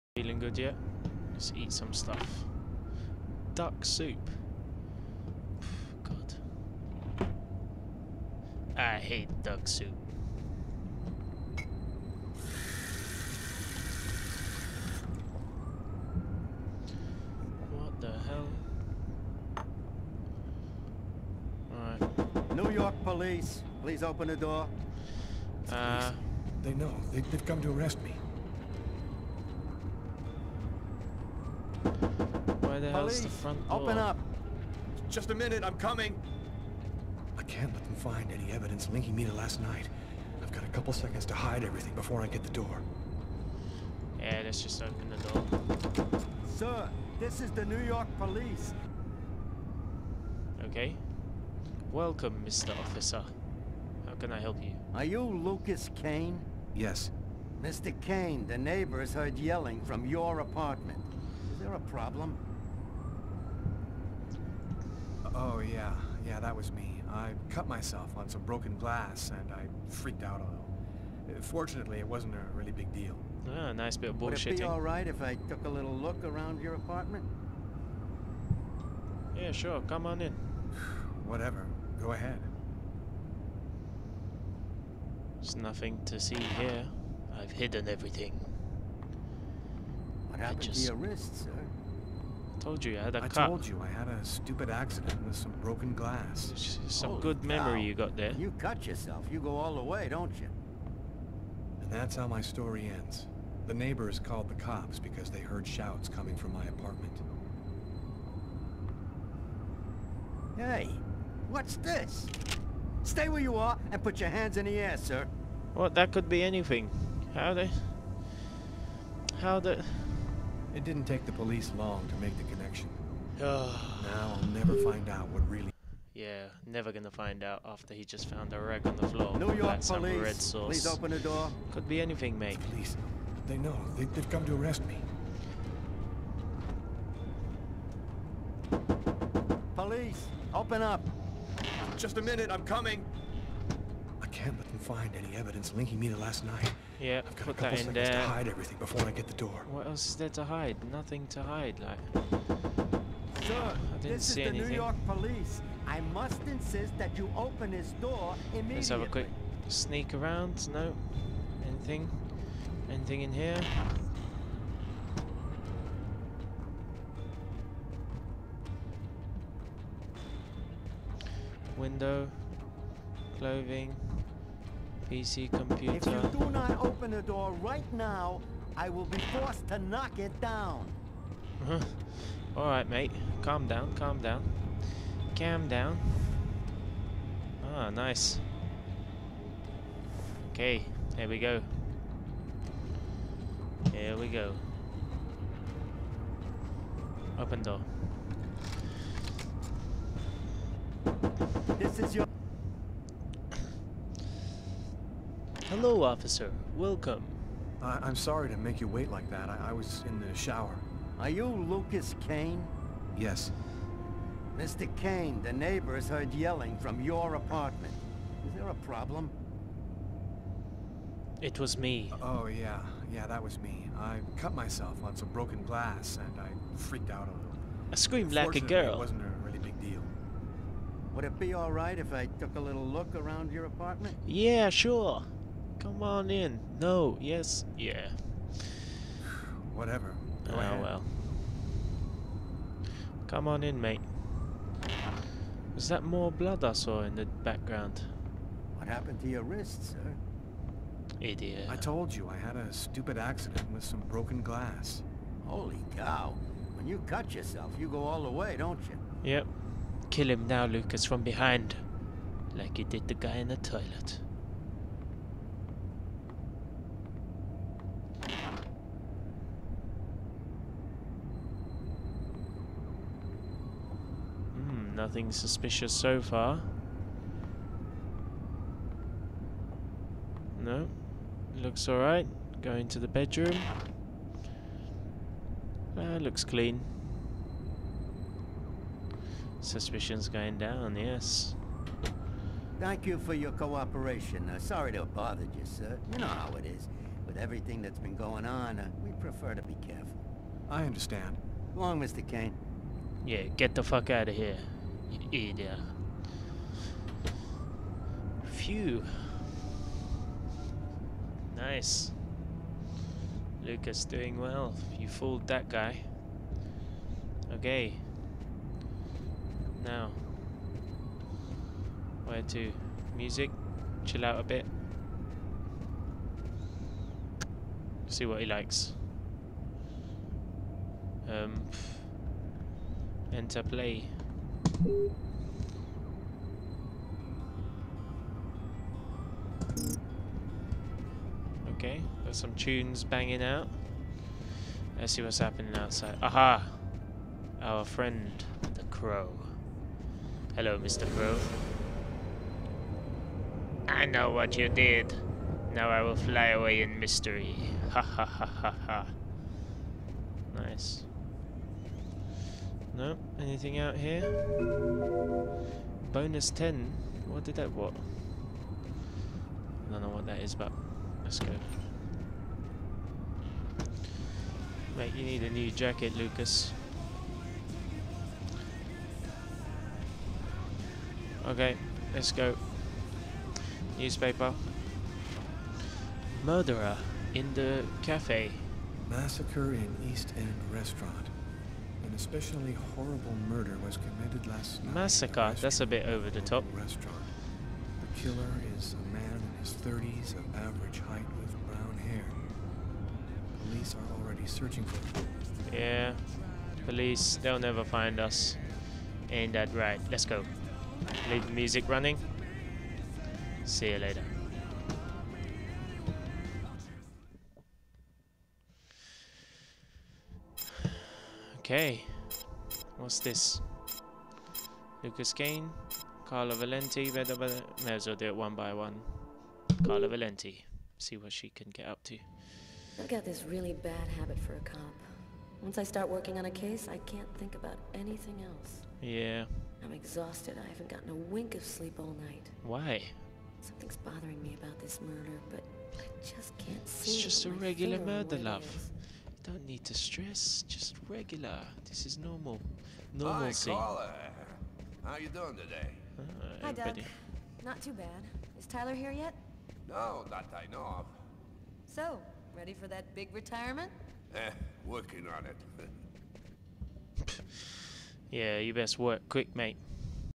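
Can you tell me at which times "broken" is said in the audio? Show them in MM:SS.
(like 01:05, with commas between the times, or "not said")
01:08, 01:35, 03:45, 04:14.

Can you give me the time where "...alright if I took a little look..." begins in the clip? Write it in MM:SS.
03:51.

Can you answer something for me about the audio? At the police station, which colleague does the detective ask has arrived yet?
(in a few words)
Tyler.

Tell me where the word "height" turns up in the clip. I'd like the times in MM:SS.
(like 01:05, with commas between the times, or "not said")
06:41.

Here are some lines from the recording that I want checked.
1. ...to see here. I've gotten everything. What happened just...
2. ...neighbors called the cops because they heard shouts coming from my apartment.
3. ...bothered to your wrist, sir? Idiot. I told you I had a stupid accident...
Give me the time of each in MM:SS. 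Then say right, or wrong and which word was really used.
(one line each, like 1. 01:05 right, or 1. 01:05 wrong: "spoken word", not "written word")
1. 01:26 wrong: "hidden", not "gotten"
2. 01:43 right
3. 04:08 wrong: "happened", not "bothered".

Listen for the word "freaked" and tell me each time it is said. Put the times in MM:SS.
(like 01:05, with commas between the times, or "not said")
01:09, 03:46.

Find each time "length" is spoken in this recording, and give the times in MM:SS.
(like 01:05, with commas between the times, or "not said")
not said.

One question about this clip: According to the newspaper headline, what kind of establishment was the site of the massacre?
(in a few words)
East End Restaurant.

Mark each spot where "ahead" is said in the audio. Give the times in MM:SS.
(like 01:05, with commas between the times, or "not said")
01:22.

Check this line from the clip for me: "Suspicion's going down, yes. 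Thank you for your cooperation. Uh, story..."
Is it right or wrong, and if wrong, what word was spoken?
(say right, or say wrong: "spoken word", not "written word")
wrong: "sorry", not "story".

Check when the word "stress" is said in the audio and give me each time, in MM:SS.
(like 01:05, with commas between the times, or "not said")
07:29.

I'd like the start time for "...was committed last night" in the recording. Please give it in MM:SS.
06:33.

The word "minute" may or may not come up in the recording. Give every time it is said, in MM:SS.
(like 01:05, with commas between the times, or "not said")
00:35, 02:22.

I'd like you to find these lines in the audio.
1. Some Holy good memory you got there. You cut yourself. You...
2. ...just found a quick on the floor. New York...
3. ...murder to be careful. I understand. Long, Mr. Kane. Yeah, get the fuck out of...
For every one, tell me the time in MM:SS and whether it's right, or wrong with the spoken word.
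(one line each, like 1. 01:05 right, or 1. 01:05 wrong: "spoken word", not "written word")
1. 01:36 right
2. 02:08 wrong: "wreck", not "quick"
3. 04:59 wrong: "prefer", not "murder".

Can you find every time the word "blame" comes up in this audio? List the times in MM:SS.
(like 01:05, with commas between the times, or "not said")
not said.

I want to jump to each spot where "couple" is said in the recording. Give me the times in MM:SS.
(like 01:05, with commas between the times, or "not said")
00:40, 02:27.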